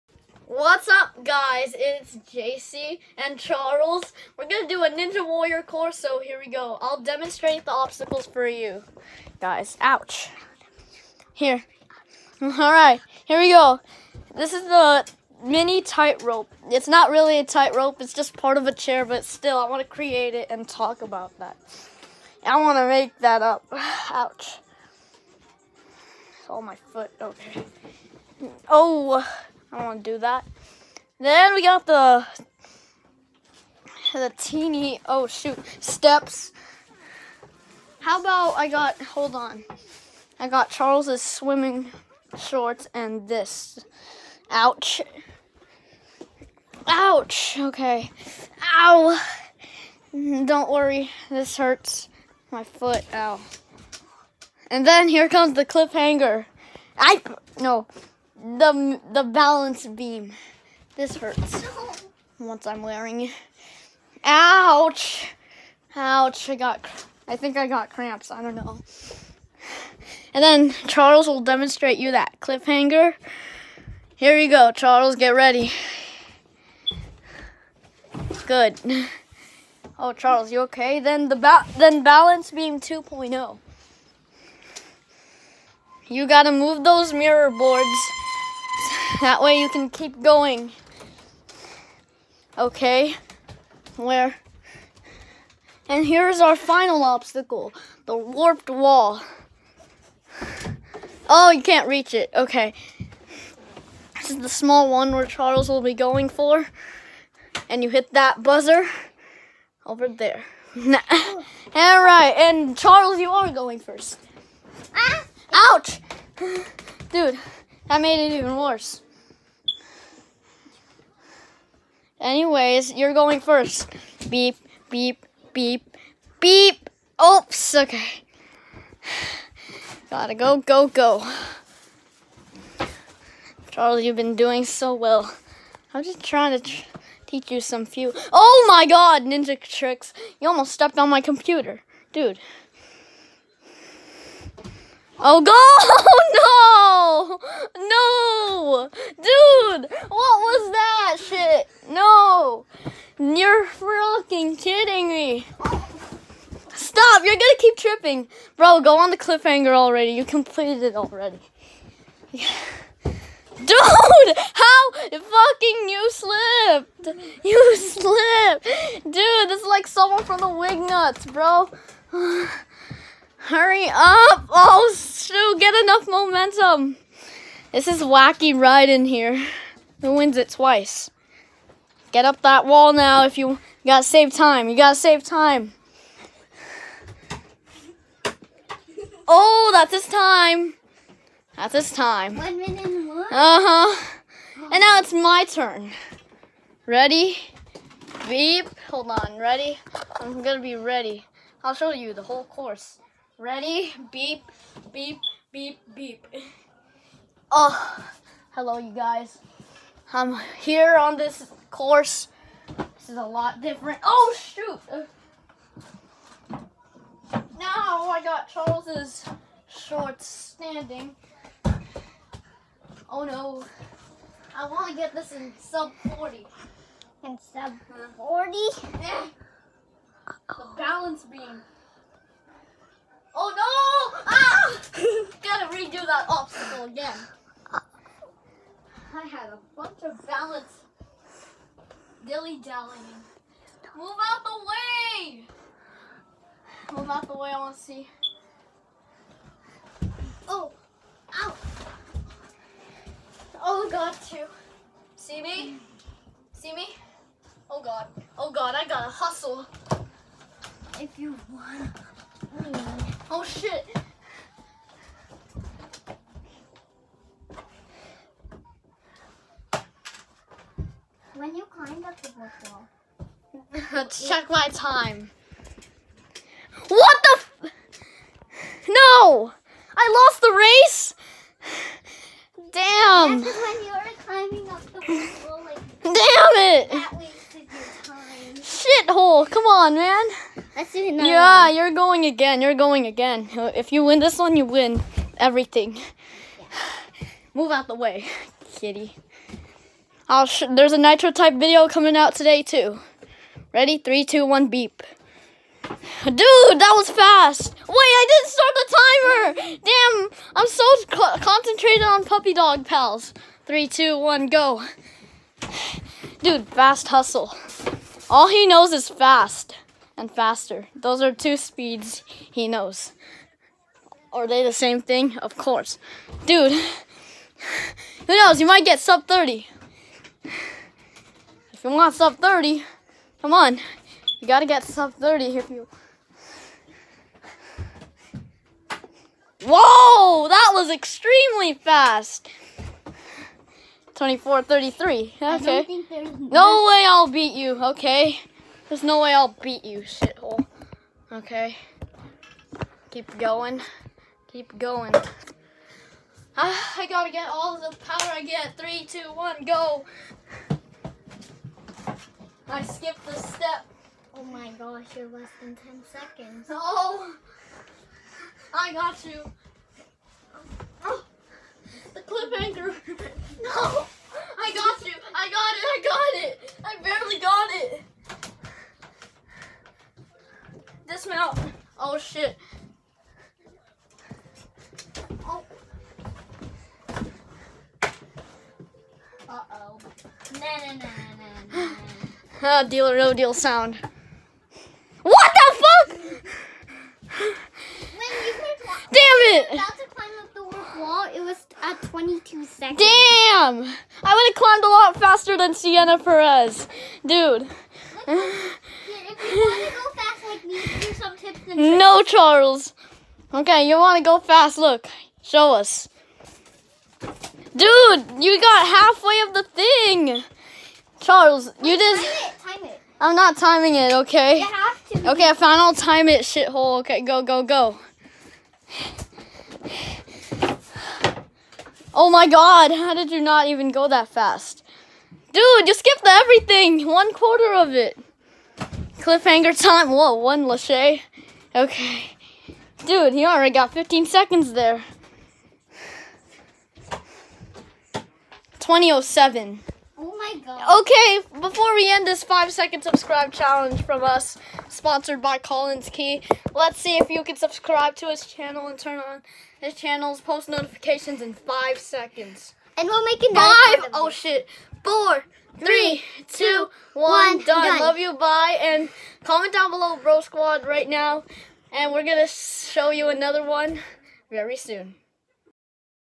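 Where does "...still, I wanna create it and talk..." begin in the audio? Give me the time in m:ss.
0:19.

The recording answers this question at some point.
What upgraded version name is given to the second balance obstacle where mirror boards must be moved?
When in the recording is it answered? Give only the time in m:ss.
1:22.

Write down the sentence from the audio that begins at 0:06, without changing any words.
I'll demonstrate the obstacles for you.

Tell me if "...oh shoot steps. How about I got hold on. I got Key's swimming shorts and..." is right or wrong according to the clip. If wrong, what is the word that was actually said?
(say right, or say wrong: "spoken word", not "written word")
wrong: "Charles", not "Key".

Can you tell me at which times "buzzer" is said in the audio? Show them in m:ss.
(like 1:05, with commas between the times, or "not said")
1:48.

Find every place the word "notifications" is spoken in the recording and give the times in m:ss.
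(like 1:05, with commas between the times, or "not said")
7:40.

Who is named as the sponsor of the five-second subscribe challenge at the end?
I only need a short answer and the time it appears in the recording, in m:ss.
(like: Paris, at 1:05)
Collins Key, at 7:35.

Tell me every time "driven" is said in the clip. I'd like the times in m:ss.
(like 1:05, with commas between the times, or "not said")
not said.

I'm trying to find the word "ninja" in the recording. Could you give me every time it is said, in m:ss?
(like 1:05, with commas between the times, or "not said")
0:04, 2:19.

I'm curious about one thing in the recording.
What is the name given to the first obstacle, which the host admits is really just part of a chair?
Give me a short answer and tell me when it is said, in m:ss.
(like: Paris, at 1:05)
mini tightrope, at 0:15.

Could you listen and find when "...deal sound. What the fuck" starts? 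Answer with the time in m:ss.
6:33.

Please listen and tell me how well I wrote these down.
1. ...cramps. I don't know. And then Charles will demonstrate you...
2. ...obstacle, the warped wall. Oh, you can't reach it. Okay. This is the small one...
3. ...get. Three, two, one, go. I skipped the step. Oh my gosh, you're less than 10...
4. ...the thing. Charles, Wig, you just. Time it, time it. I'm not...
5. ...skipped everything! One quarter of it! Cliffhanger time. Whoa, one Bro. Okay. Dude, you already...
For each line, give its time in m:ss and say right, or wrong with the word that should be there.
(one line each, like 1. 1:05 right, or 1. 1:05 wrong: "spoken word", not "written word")
1. 1:07 right
2. 1:37 right
3. 5:58 right
4. 6:59 wrong: "Wait", not "Wig"
5. 7:15 wrong: "Lachey", not "Bro".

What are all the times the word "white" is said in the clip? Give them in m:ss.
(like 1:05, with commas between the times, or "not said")
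not said.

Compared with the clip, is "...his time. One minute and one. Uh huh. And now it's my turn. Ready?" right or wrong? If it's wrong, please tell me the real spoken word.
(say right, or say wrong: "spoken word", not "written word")
right.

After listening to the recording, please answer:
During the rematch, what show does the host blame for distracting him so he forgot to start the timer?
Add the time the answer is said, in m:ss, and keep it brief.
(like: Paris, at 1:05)
Puppy Dog Pals, at 5:12.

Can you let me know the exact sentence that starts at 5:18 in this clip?
All he knows is fast and faster.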